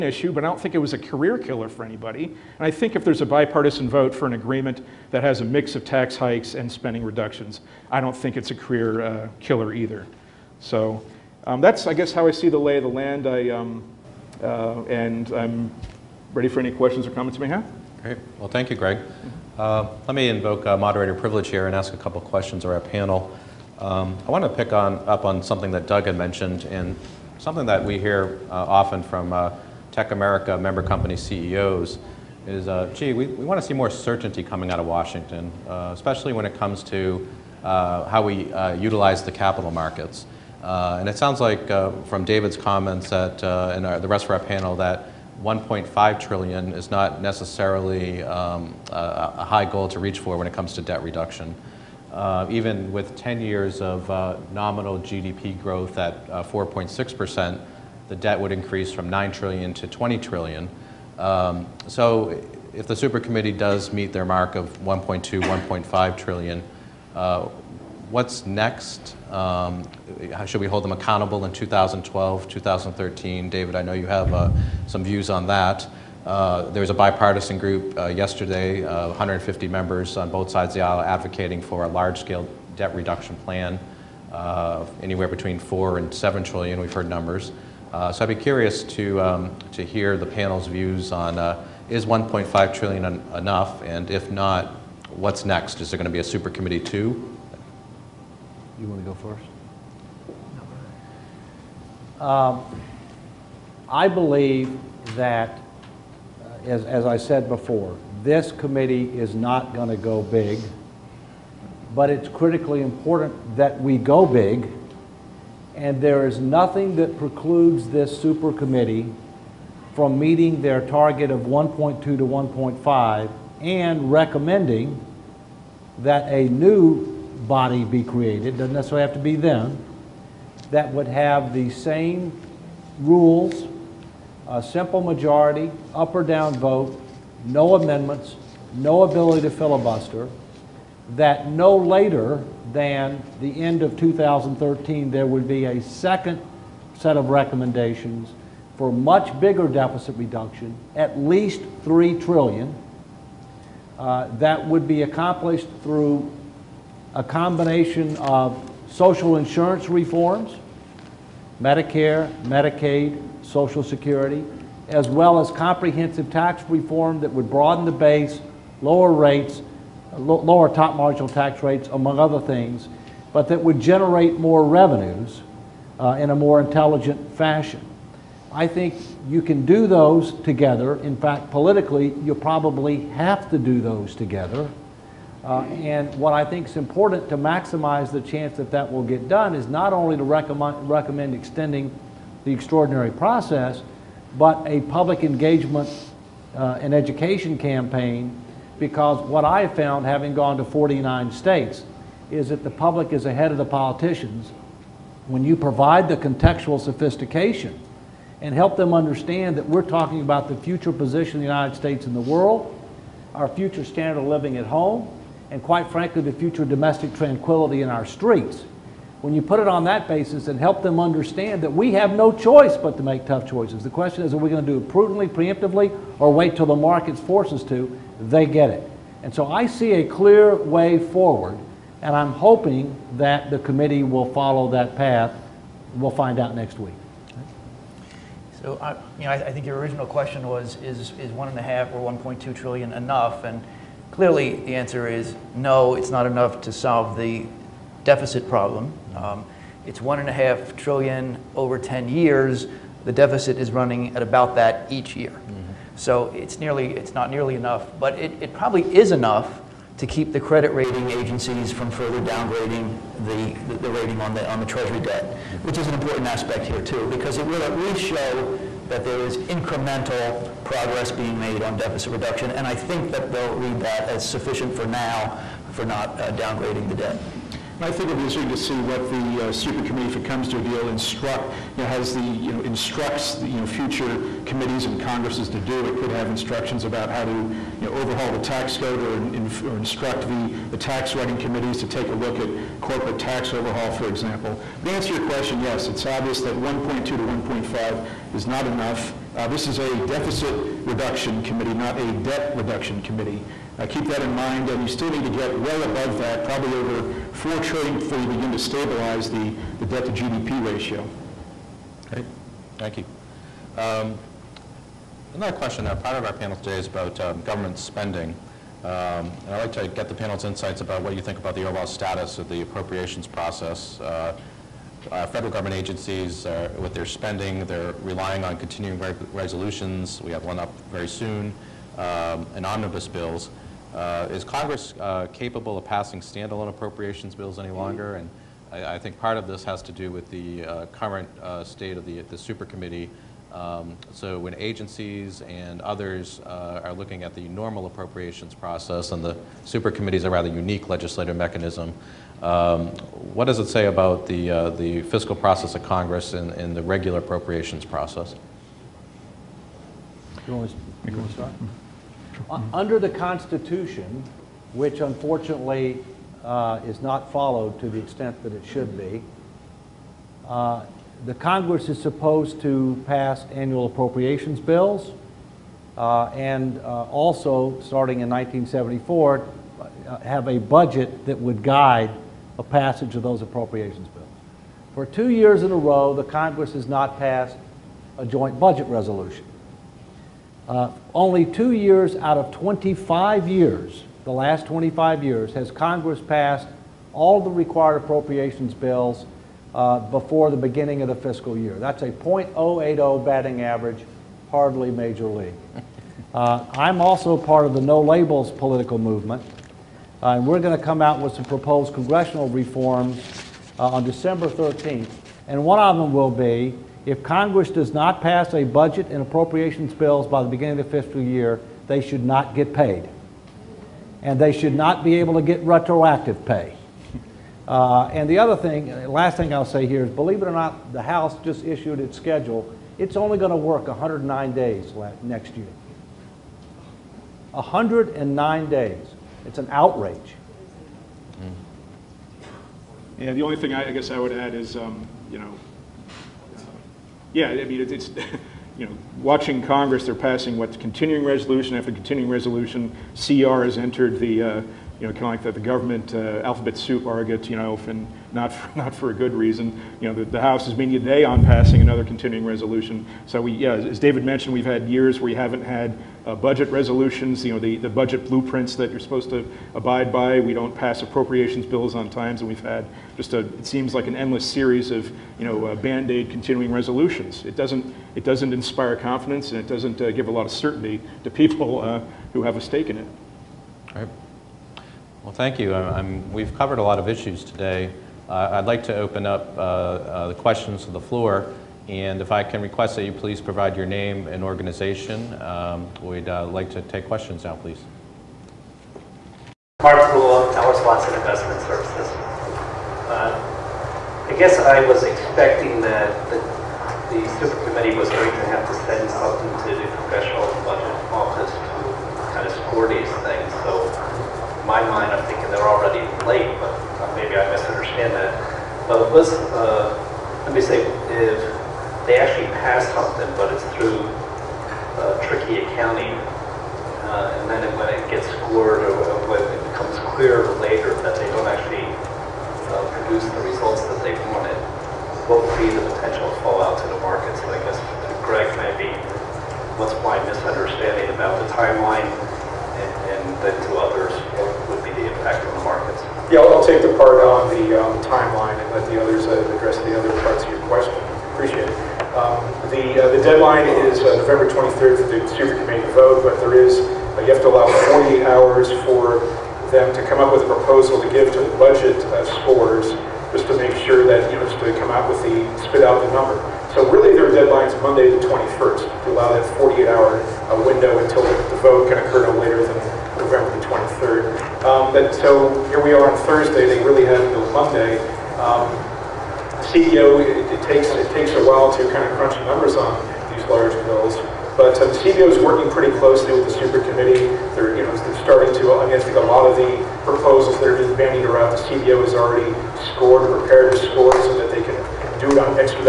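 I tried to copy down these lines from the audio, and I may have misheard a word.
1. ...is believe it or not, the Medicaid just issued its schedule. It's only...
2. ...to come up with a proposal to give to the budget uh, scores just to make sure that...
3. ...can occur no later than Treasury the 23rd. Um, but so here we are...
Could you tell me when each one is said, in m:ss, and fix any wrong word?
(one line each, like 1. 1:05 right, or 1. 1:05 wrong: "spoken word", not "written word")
1. 7:10 wrong: "House", not "Medicaid"
2. 9:19 right
3. 9:31 wrong: "November", not "Treasury".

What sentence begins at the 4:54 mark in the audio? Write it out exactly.
But to answer your question, yes, it's obvious that 1.2 to 1.5 is not enough.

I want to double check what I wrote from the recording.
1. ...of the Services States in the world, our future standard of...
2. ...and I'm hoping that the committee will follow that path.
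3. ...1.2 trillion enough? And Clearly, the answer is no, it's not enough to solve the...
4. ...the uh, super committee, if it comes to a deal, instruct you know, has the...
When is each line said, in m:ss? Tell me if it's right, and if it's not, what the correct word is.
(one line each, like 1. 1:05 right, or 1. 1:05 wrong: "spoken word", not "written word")
1. 3:31 wrong: "United", not "Services"
2. 3:52 right
3. 4:02 right
4. 4:39 right.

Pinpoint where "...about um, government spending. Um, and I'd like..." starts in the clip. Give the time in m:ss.
5:16.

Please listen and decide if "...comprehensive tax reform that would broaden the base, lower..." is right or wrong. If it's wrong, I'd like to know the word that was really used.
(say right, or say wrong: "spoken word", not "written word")
right.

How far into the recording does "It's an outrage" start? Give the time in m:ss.
7:19.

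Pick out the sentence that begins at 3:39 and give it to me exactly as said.
When you put it on that basis and help them understand that we have no choice but to make tough choices.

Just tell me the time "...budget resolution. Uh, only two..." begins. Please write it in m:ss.
6:28.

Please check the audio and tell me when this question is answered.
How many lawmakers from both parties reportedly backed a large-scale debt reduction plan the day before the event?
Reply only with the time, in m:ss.
1:19.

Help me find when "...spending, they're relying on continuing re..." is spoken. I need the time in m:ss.
5:27.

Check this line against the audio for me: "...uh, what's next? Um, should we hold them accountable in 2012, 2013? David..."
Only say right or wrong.
right.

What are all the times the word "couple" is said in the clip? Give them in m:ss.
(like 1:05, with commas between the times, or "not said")
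0:21.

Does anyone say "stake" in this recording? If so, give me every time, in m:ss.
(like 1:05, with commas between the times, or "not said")
8:02.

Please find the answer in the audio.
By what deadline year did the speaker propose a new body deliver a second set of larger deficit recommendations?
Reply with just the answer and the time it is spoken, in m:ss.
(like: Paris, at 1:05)
2013, at 2:23.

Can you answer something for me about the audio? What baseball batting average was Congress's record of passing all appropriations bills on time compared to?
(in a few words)
.080.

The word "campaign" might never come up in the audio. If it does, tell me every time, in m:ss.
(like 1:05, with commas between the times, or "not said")
3:17.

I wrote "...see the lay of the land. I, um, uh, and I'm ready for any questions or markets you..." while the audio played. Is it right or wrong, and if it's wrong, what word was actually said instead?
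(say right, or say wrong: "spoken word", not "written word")
wrong: "comments", not "markets".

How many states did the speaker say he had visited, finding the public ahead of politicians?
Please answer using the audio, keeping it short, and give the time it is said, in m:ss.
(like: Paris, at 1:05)
49, at 3:20.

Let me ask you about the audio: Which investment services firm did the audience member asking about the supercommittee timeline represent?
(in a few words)
Towers Watson.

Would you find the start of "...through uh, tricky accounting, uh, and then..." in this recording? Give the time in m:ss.
8:43.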